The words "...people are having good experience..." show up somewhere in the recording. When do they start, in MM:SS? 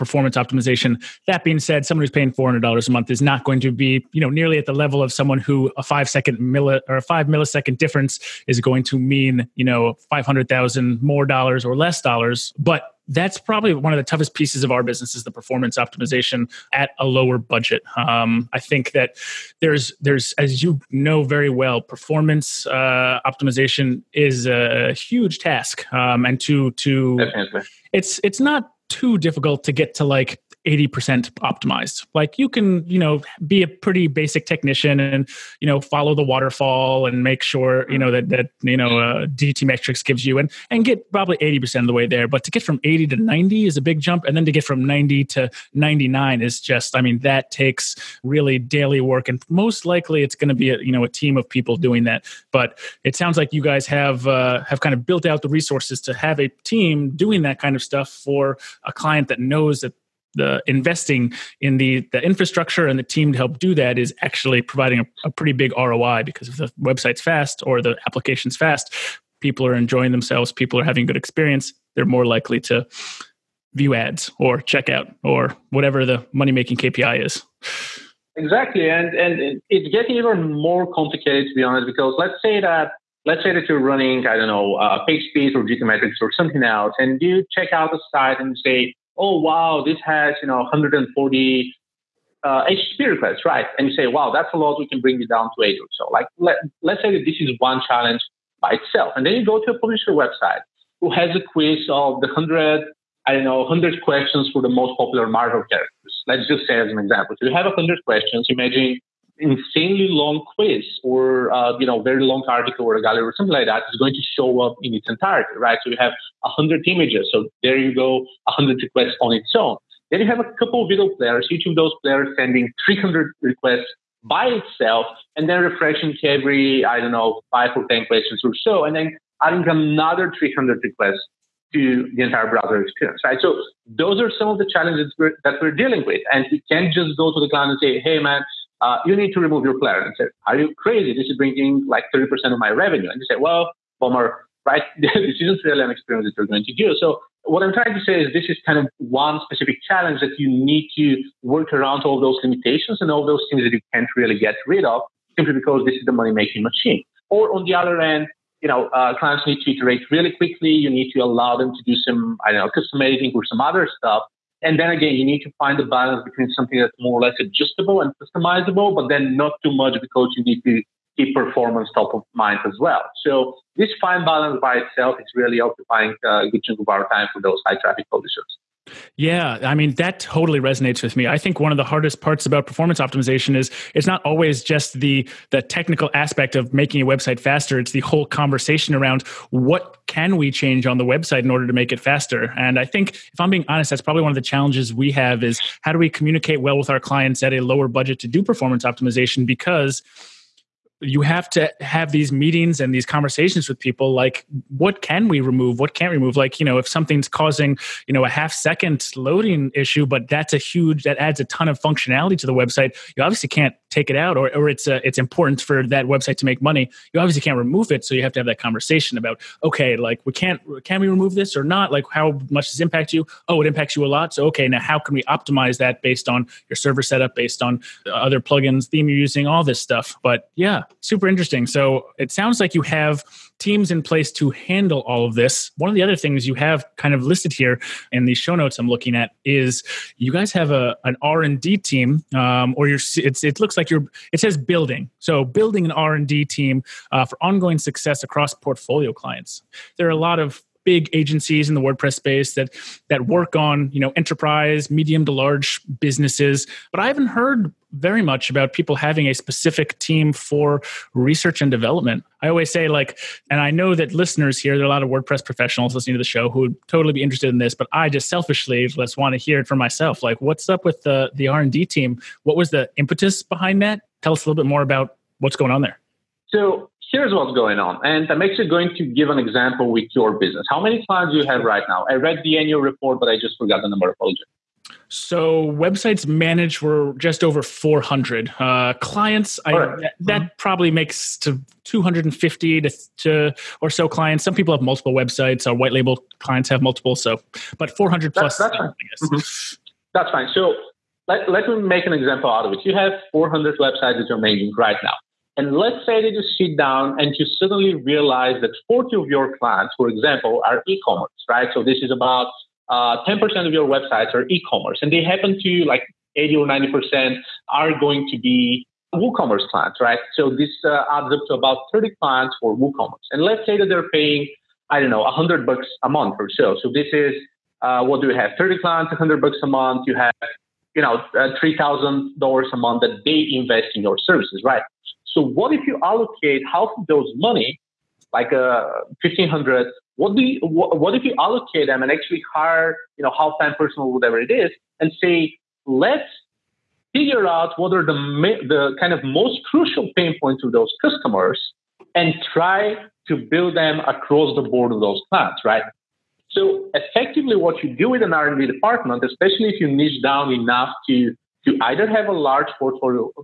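01:10.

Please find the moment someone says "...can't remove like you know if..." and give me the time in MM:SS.
03:25.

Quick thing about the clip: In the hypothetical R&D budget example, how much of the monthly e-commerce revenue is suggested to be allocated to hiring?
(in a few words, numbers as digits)
1,500.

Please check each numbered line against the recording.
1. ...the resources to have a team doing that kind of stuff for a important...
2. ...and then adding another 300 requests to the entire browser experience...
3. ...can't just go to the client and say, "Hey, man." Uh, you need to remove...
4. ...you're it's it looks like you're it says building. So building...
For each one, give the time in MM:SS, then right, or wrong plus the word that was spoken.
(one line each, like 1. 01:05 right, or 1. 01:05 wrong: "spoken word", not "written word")
1. 00:55 wrong: "client", not "important"
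2. 02:08 right
3. 02:16 right
4. 04:02 right.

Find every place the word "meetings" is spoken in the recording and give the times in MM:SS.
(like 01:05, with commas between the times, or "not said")
03:22.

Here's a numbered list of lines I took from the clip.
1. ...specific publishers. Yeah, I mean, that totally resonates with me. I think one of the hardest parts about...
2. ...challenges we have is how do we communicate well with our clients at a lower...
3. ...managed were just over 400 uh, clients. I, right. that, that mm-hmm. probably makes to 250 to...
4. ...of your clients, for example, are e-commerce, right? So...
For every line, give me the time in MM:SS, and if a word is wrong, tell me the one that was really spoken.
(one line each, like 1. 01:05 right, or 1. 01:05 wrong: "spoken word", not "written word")
1. 02:57 wrong: "traffic", not "specific"
2. 03:14 right
3. 04:46 right
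4. 05:09 right.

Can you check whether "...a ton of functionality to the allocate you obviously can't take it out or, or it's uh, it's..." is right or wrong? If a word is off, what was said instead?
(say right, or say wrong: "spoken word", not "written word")
wrong: "website", not "allocate".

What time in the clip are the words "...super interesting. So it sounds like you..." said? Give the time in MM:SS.
03:50.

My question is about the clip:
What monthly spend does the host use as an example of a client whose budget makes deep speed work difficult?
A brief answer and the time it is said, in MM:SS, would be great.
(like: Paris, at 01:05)
$400, at 00:02.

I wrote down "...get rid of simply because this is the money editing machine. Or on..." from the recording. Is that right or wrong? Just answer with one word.
wrong.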